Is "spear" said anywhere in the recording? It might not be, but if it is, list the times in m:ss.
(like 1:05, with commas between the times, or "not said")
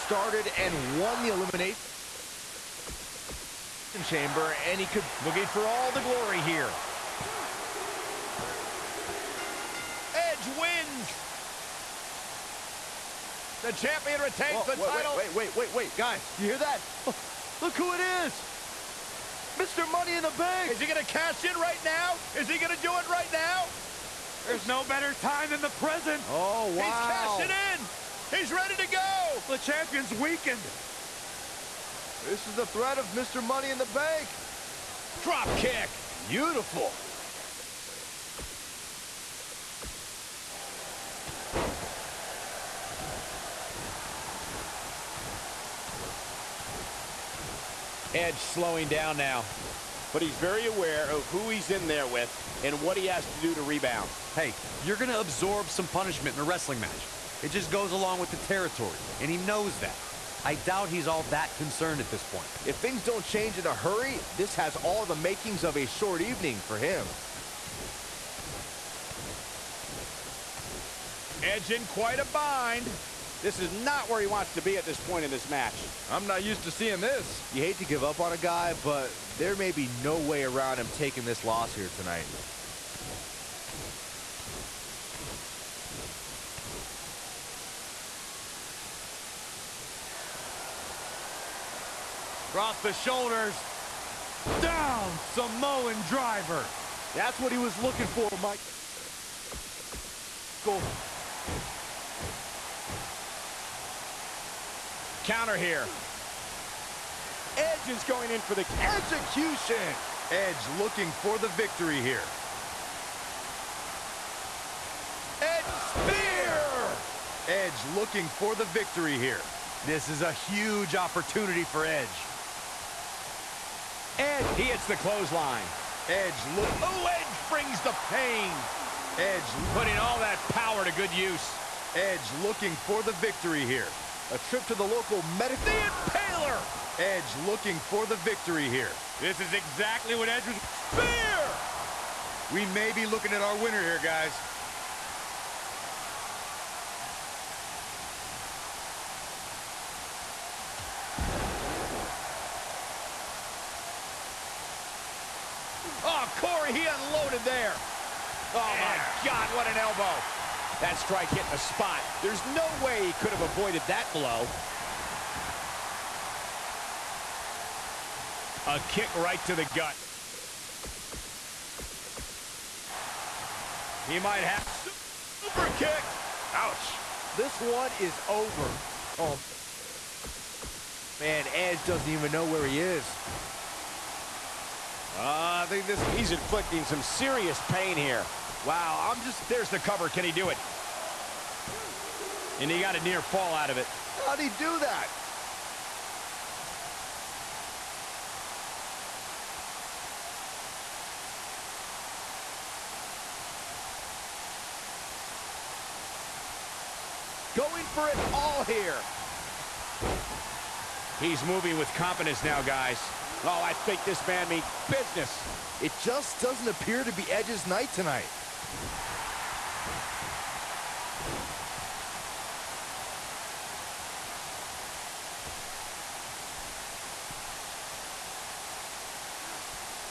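1:55, 2:20.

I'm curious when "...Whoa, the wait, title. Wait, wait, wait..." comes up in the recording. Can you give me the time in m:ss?
0:14.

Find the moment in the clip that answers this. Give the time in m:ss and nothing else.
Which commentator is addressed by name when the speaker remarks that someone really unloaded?
2:36.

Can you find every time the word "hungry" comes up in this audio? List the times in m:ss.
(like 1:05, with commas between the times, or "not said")
not said.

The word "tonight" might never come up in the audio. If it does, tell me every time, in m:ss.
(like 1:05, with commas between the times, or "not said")
1:21, 3:37.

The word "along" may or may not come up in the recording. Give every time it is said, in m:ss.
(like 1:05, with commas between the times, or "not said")
0:57.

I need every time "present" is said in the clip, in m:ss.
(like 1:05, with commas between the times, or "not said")
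0:25.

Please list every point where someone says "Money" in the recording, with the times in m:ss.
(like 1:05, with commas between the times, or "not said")
0:19, 0:33.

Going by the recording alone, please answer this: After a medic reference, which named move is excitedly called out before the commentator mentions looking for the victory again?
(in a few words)
The Impaler.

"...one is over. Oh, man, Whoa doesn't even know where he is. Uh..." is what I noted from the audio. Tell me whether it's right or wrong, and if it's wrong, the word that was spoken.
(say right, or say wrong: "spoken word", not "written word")
wrong: "Edge", not "Whoa".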